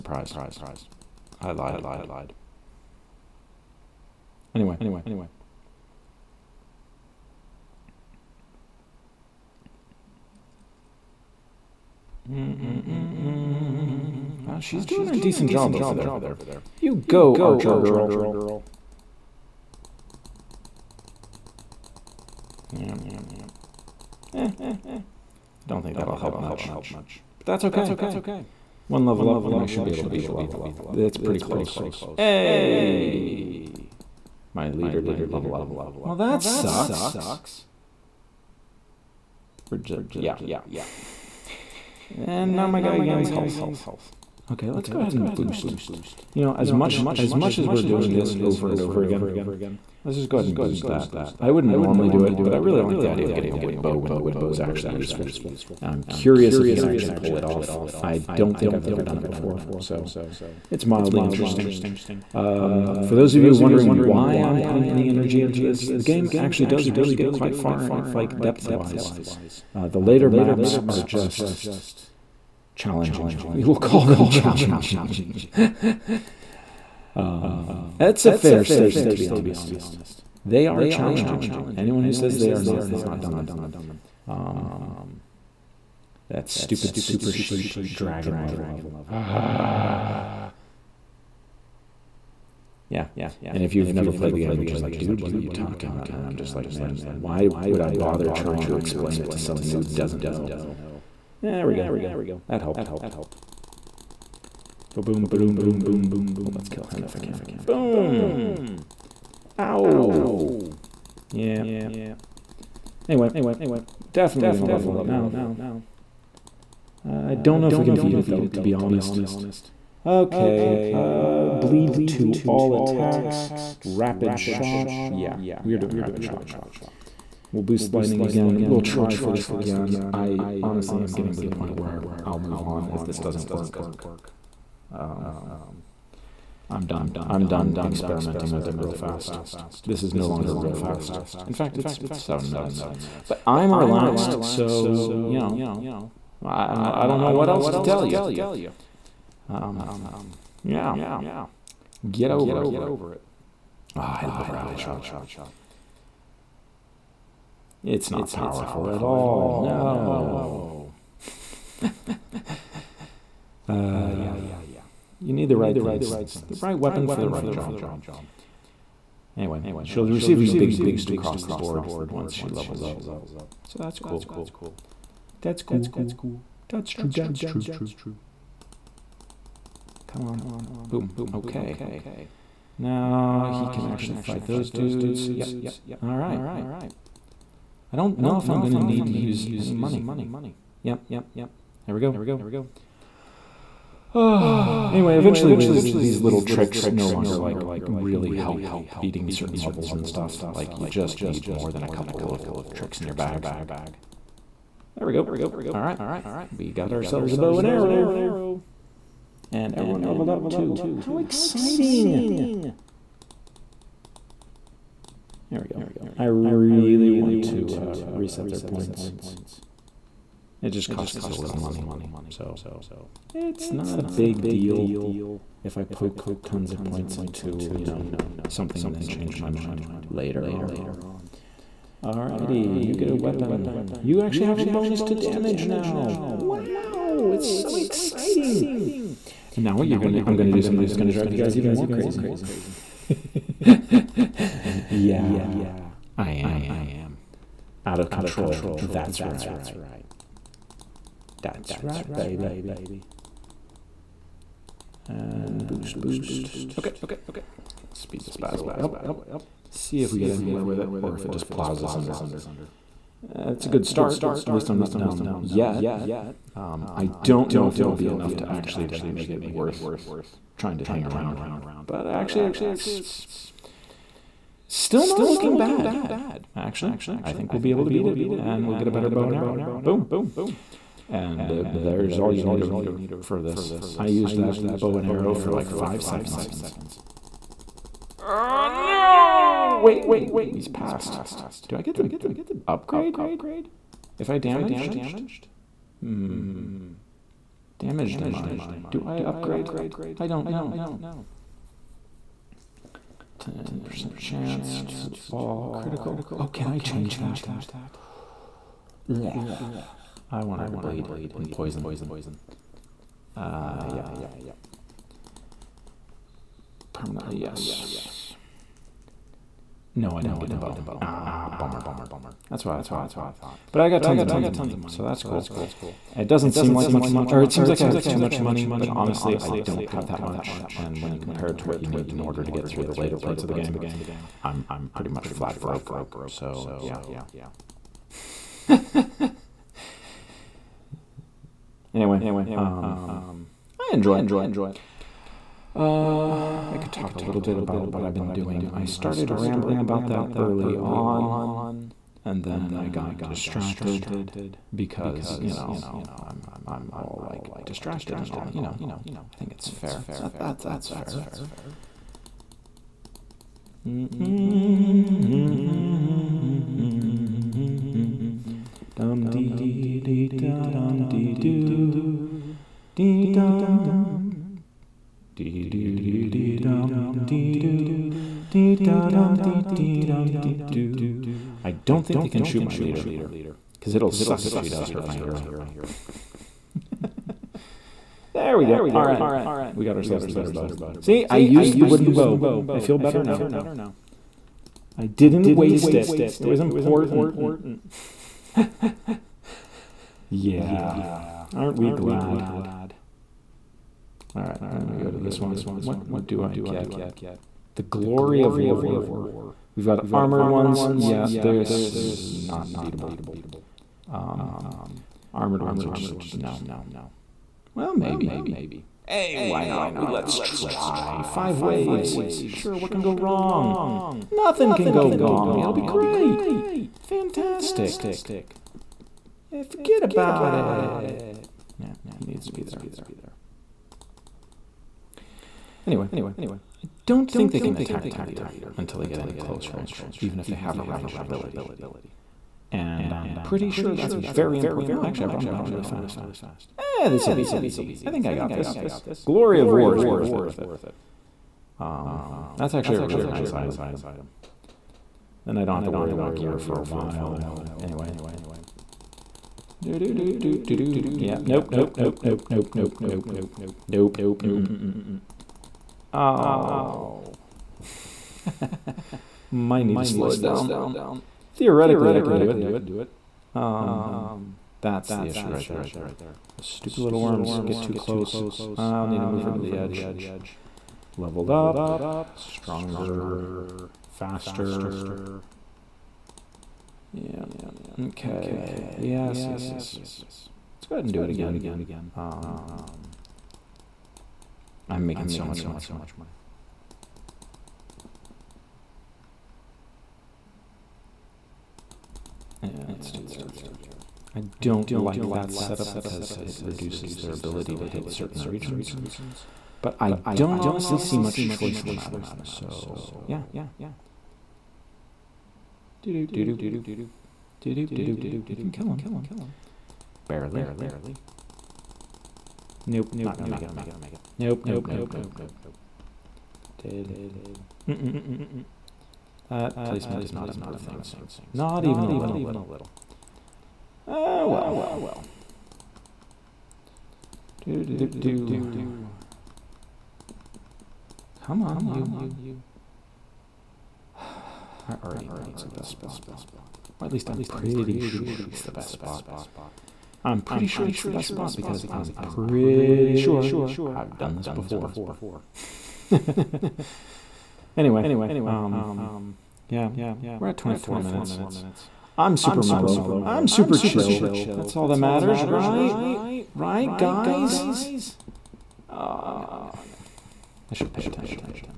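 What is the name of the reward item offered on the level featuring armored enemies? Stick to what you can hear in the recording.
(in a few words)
The Glory of War.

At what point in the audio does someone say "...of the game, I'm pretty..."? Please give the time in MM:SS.
05:33.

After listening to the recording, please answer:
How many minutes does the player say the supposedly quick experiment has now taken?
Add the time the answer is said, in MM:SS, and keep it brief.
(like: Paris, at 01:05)
7, at 02:22.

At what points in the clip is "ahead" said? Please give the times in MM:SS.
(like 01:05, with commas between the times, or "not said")
00:44, 00:50, 08:10.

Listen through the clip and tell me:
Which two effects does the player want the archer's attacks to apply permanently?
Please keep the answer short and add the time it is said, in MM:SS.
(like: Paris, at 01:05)
bleed and poison, at 05:10.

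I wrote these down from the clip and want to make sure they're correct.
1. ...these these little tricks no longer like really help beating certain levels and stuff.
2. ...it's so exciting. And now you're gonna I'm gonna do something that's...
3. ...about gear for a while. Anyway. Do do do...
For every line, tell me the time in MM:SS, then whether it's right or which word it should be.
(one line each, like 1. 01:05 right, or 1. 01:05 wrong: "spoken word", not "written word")
1. 03:15 right
2. 03:57 right
3. 07:36 right.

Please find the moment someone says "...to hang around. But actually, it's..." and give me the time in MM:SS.
04:30.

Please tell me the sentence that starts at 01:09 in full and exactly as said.
Uh, the later maps are just challenging.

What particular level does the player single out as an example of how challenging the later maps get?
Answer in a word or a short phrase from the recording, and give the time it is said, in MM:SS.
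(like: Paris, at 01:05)
super sheep dragon level, at 01:26.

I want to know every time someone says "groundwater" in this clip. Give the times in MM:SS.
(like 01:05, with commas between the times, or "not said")
not said.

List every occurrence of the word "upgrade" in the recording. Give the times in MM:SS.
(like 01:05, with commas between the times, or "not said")
04:52, 04:59.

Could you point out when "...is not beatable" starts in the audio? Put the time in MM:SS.
06:51.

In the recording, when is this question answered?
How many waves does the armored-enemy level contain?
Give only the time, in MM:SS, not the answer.
07:01.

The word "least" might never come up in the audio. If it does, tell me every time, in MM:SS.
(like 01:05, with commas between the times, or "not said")
04:24, 09:07.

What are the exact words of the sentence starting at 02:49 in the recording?
Anyway, she'll receive a big boost across the board once she levels up.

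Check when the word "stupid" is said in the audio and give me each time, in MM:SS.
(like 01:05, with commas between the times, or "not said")
01:26, 07:56.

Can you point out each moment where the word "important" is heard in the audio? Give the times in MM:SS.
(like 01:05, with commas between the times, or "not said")
06:36, 07:24.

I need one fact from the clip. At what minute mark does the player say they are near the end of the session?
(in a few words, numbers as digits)
24.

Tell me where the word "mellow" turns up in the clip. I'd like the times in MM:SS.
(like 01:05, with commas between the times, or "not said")
09:22.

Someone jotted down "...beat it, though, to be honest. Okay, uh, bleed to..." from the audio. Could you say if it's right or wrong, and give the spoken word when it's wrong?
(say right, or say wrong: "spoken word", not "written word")
right.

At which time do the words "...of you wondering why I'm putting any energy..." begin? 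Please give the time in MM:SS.
01:03.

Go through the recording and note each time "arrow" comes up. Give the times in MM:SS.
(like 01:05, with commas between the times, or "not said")
03:27, 04:39, 04:45.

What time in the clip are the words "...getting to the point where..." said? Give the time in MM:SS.
02:11.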